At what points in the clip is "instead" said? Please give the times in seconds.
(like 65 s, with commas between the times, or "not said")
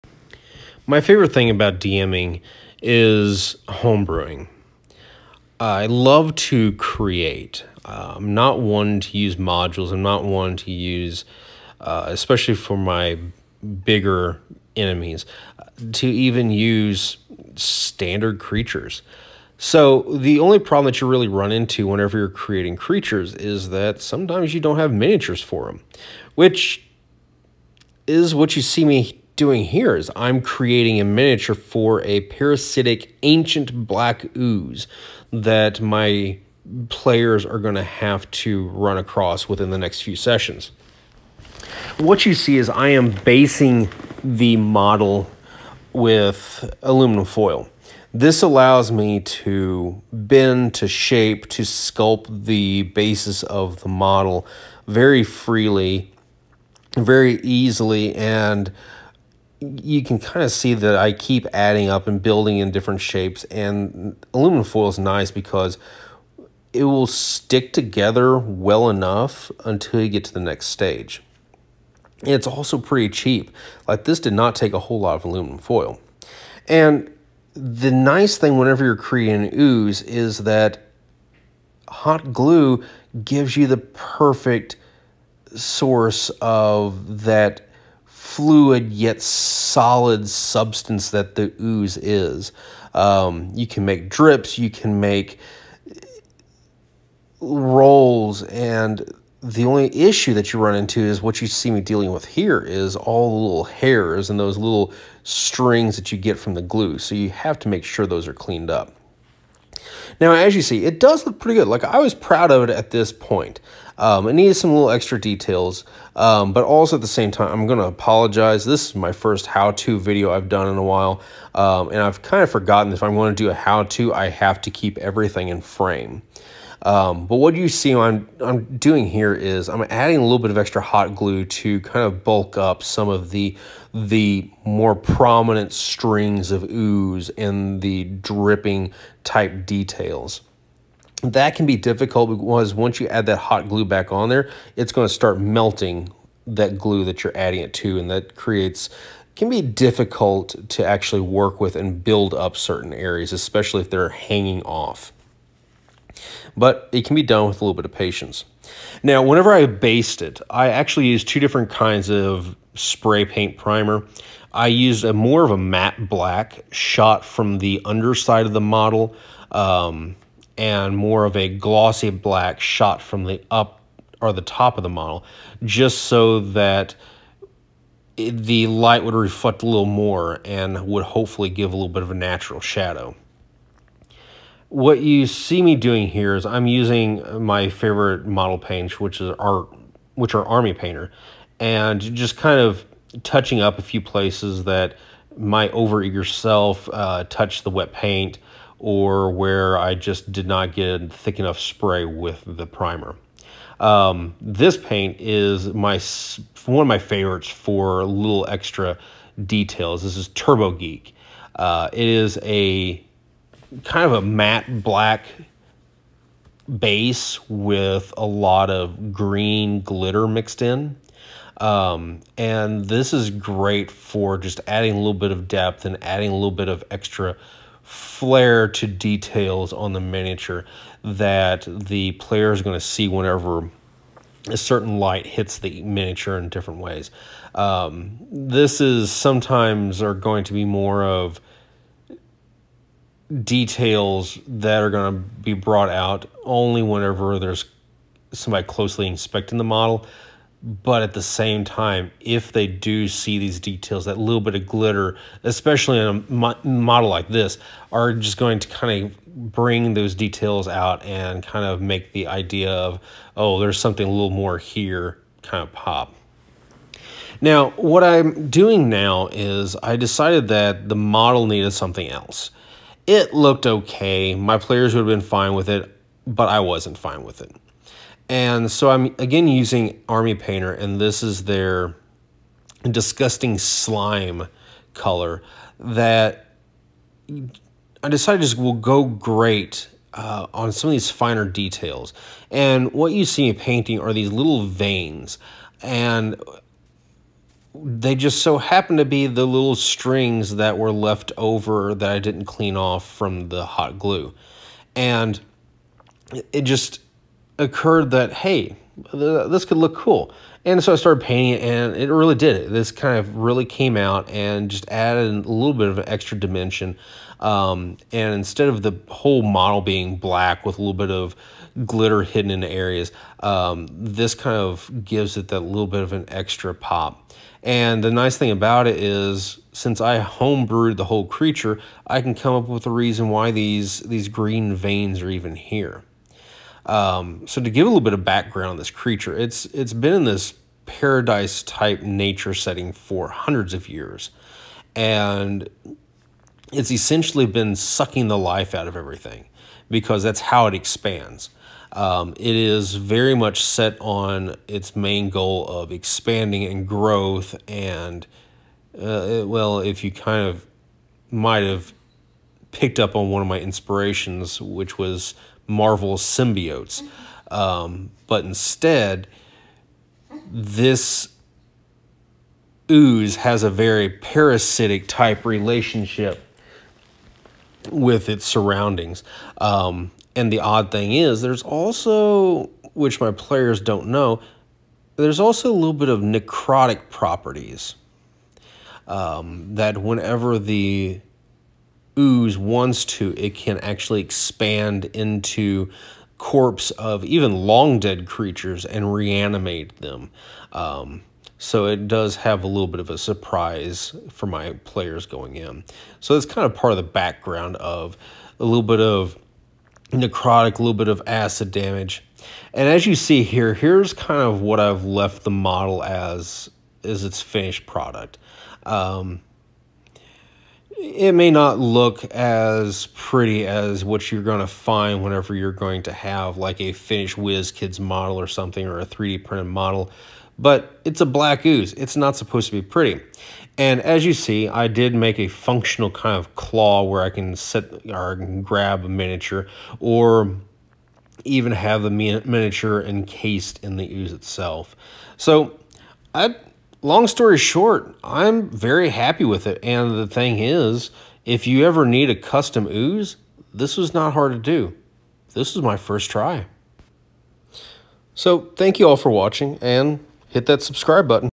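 318 s, 368 s.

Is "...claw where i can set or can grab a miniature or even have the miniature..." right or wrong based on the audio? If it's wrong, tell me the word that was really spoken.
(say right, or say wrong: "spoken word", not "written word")
right.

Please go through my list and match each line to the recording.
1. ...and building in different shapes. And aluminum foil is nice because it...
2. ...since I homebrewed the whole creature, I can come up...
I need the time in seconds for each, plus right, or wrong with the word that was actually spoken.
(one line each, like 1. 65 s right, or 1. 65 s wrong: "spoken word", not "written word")
1. 62 s right
2. 329 s right.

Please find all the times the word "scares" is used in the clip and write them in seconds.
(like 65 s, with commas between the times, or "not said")
not said.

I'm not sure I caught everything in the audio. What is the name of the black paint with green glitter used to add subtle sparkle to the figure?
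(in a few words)
Turbo Geek.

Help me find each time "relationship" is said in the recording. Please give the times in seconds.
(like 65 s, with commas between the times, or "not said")
375 s.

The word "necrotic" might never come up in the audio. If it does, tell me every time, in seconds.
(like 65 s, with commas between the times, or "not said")
386 s, 410 s.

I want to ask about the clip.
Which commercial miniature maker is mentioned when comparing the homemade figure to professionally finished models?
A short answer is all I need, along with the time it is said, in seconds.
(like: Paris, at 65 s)
WizKids, at 427 s.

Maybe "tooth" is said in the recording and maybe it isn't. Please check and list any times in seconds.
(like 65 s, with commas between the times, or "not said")
not said.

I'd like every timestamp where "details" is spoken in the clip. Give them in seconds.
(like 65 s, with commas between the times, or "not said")
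115 s, 139 s, 209 s, 228 s, 243 s, 253 s, 260 s, 291 s.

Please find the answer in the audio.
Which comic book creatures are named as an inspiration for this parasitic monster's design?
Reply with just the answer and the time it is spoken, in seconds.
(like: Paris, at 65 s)
Marvel symbiotes, at 365 s.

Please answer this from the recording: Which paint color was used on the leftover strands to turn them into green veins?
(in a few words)
disgusting slime.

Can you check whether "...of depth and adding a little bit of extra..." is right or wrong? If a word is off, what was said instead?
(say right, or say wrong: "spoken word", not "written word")
right.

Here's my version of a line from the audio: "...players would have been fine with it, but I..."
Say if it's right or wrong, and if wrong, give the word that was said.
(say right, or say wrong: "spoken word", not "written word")
right.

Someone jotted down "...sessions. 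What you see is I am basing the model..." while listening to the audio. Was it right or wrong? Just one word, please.
right.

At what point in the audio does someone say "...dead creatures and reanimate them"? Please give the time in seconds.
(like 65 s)
397 s.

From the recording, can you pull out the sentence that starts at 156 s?
But it can be done with a little bit of patience.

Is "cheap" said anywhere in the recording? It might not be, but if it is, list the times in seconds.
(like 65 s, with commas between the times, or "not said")
73 s.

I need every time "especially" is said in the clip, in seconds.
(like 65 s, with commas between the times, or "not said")
12 s, 153 s, 255 s.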